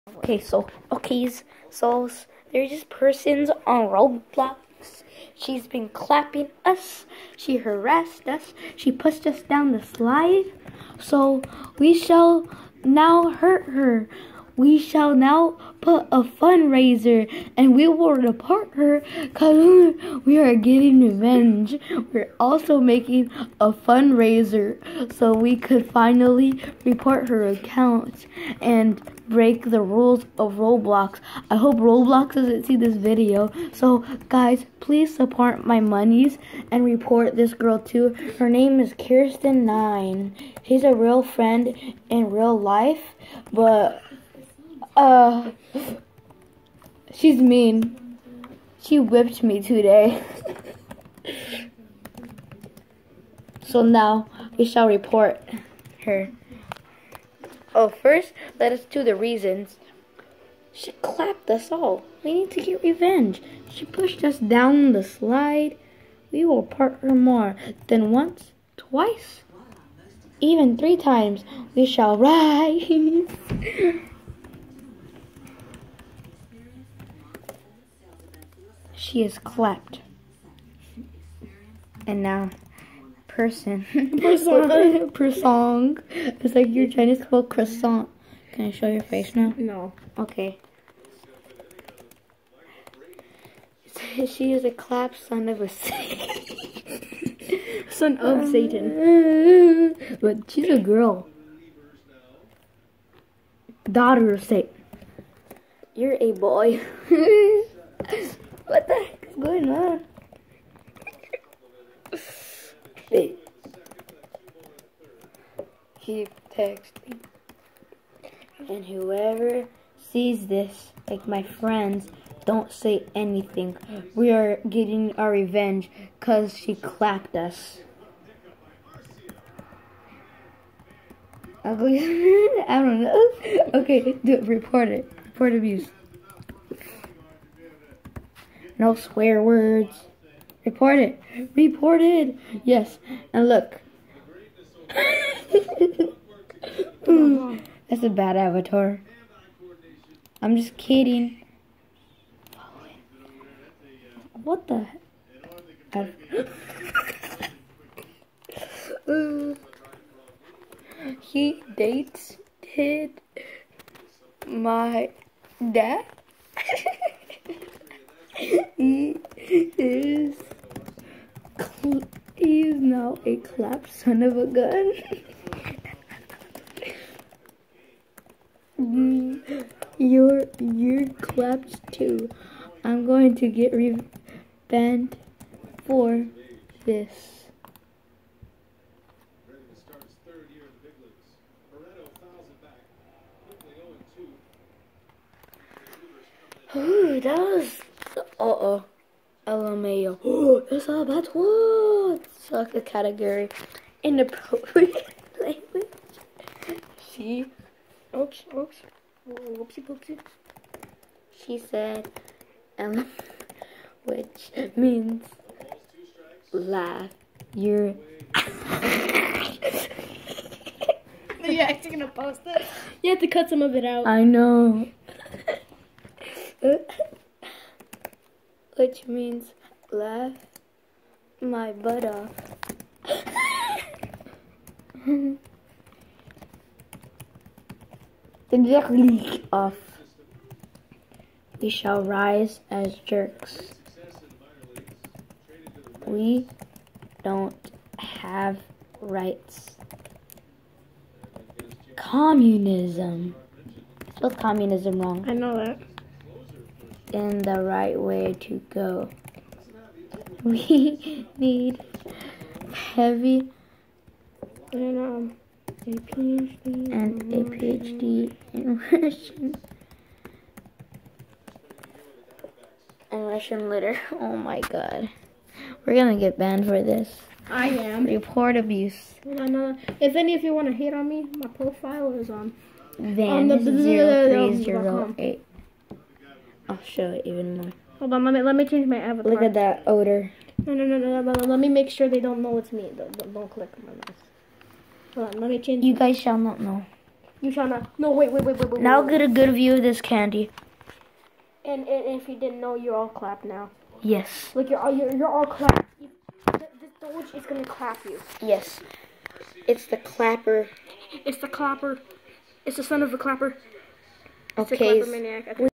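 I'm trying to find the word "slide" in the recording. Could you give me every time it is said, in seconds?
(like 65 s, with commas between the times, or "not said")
9 s, 65 s.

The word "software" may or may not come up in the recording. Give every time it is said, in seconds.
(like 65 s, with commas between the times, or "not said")
not said.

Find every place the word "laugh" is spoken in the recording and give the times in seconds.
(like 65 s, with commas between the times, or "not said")
216 s, 229 s.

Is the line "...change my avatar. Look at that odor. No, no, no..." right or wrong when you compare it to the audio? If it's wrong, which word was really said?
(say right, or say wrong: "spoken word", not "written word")
right.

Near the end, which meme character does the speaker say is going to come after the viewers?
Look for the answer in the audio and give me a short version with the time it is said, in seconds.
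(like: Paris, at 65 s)
Doge, at 307 s.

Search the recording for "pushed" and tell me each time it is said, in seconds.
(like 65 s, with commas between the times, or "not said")
8 s, 63 s.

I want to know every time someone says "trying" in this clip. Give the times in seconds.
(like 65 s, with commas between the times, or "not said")
86 s.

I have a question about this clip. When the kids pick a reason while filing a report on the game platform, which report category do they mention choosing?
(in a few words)
Inappropriate language.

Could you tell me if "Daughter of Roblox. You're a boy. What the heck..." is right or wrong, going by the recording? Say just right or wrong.
wrong.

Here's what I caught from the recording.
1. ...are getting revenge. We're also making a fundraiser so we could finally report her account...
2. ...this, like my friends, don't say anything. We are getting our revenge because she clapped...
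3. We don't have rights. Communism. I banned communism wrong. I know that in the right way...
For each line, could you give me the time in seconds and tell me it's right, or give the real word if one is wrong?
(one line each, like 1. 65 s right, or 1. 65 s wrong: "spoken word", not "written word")
1. 20 s right
2. 120 s right
3. 246 s wrong: "spelled", not "banned".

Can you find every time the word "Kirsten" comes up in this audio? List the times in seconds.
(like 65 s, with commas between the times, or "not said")
38 s.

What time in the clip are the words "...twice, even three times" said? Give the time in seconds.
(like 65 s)
68 s.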